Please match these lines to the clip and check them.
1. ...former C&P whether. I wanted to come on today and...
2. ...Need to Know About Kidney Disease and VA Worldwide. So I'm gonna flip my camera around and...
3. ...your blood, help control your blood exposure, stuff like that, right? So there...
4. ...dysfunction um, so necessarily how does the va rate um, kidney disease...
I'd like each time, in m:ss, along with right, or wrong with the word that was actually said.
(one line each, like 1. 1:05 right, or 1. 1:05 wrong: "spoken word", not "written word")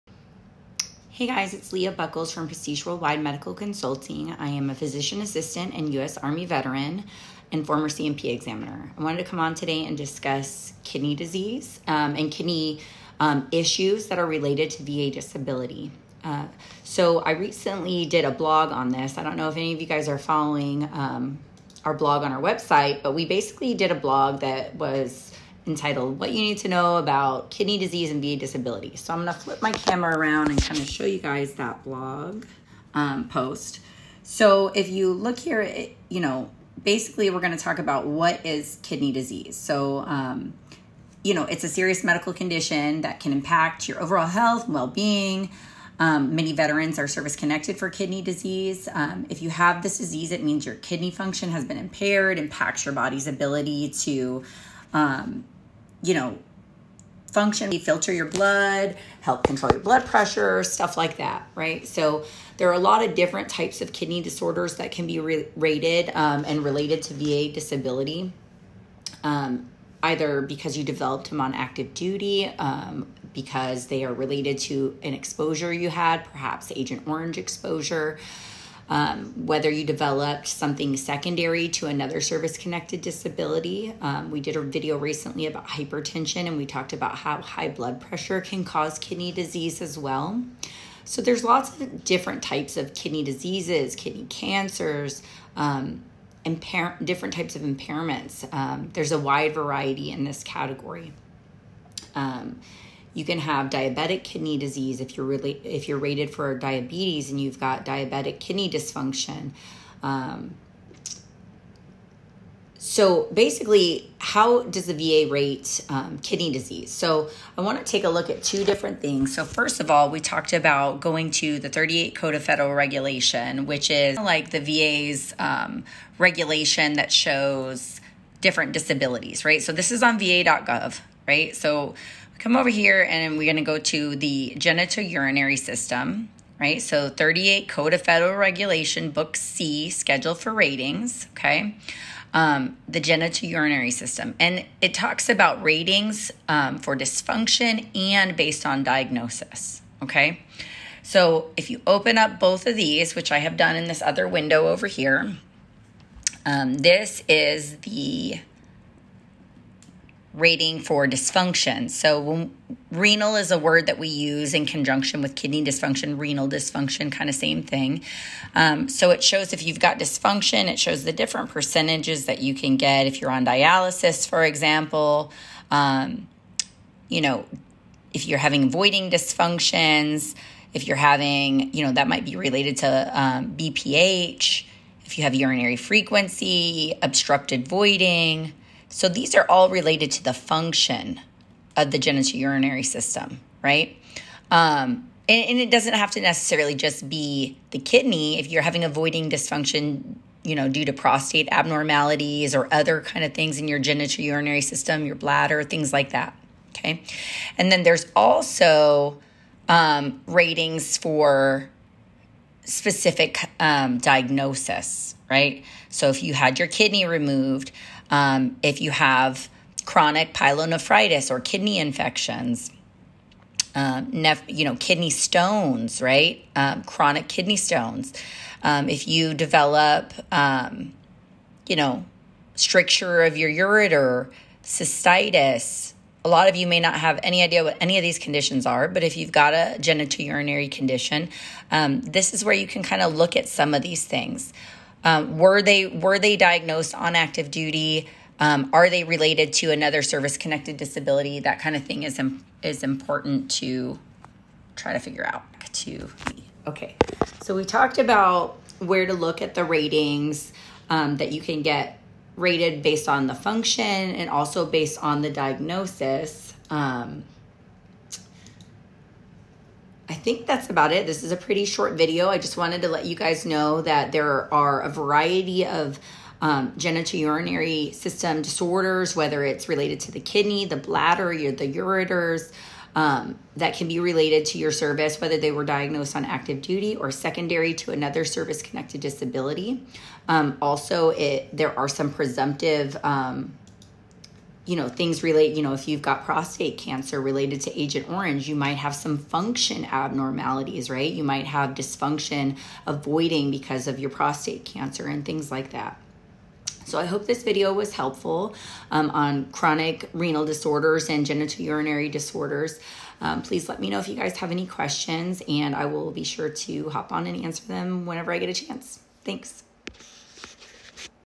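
1. 0:07 wrong: "examiner", not "whether"
2. 0:26 wrong: "Disability", not "Worldwide"
3. 0:58 wrong: "pressure", not "exposure"
4. 1:48 wrong: "basically", not "necessarily".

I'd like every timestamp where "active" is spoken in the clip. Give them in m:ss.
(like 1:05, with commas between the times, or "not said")
1:11, 4:07, 4:46.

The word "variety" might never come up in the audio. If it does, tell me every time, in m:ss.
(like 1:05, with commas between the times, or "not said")
1:39, 4:34.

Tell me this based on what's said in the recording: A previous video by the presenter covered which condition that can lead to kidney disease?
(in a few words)
Hypertension.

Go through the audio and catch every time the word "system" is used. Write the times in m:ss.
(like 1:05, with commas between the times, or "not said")
2:15, 2:23, 3:12, 3:24, 4:37.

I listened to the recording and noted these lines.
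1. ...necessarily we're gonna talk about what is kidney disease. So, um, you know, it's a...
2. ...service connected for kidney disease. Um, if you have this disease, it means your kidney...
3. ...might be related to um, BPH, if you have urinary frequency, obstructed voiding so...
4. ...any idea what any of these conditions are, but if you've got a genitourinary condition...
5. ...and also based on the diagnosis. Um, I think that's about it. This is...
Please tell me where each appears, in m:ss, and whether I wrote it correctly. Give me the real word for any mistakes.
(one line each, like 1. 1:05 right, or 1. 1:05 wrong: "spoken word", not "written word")
1. 0:36 wrong: "basically", not "necessarily"
2. 0:47 right
3. 3:02 right
4. 3:57 right
5. 4:23 right.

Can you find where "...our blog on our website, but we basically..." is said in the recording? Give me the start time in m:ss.
0:21.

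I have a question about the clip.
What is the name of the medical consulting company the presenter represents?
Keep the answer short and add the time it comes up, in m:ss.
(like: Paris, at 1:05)
Prestige Worldwide Medical Consulting, at 0:02.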